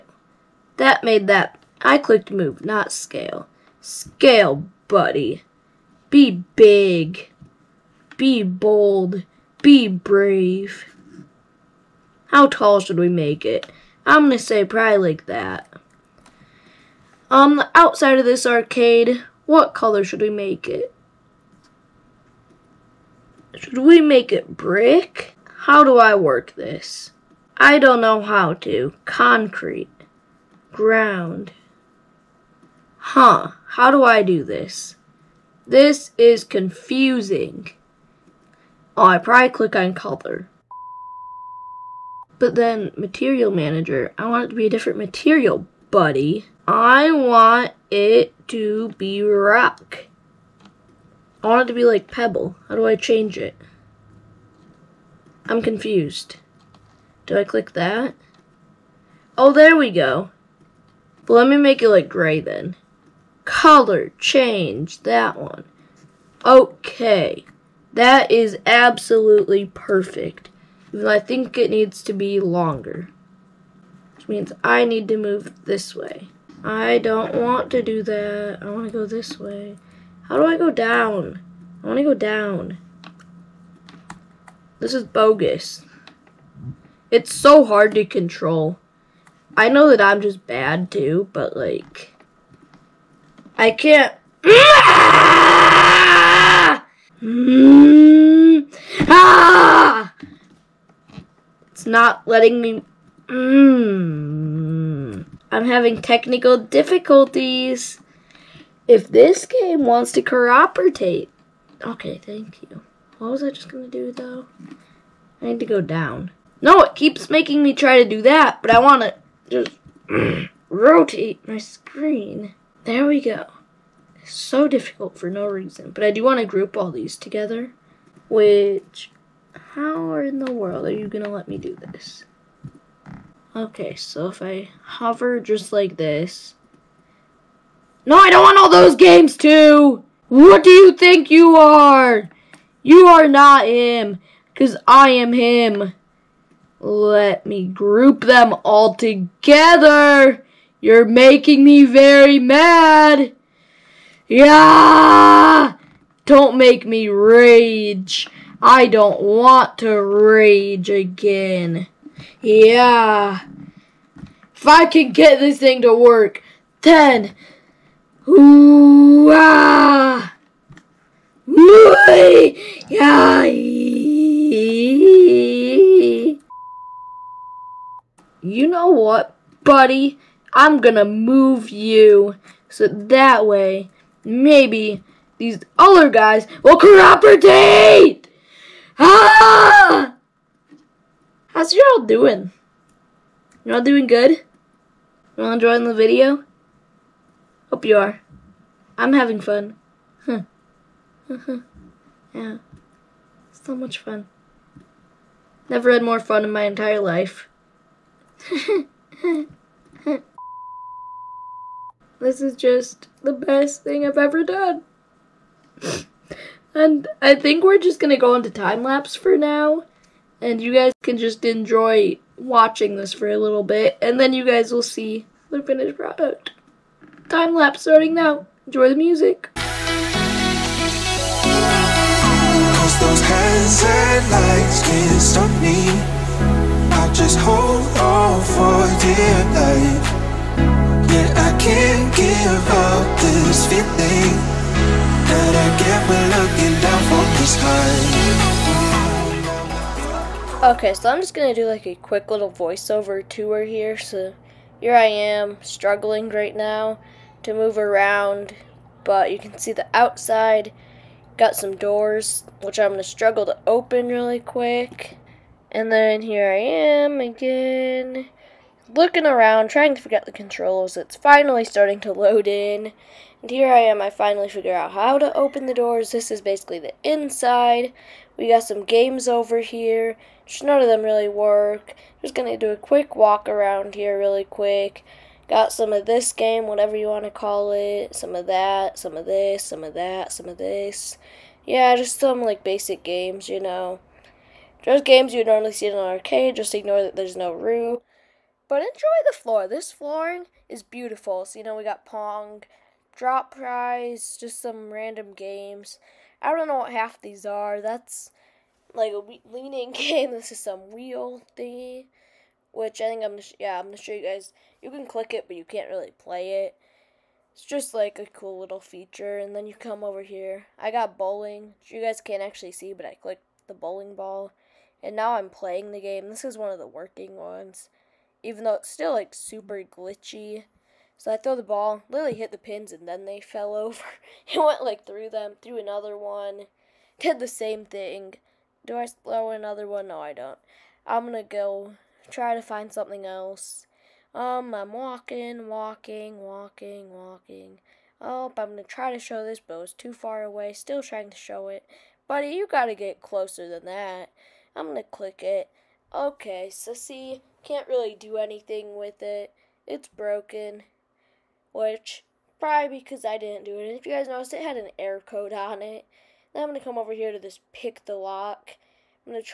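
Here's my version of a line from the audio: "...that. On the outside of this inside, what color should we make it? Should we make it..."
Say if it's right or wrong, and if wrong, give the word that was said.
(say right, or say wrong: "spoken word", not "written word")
wrong: "arcade", not "inside".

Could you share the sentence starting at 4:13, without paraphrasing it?
So here I am, struggling right now to move around, but you can see the outside.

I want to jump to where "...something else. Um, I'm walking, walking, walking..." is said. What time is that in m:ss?
5:42.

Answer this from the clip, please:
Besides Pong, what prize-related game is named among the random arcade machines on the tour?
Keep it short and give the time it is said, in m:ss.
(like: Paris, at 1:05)
Drop Prize, at 5:03.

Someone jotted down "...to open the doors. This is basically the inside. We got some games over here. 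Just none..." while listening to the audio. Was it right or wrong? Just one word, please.
right.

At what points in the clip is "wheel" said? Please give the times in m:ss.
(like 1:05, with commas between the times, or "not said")
5:10.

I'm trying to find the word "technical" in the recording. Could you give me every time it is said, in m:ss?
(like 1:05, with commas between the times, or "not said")
1:46.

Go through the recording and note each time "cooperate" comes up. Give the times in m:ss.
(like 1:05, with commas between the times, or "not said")
1:50, 3:06.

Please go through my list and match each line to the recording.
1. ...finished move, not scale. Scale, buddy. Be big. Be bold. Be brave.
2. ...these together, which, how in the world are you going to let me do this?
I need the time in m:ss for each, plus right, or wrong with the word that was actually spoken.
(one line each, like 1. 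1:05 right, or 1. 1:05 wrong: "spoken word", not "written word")
1. 0:01 wrong: "clicked", not "finished"
2. 2:06 right.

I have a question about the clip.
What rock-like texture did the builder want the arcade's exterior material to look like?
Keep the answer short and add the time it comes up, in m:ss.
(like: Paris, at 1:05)
Pebble, at 0:52.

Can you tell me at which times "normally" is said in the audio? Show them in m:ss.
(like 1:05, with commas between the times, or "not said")
4:55.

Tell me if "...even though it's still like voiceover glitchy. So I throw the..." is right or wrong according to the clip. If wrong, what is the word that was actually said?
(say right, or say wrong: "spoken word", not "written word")
wrong: "super", not "voiceover".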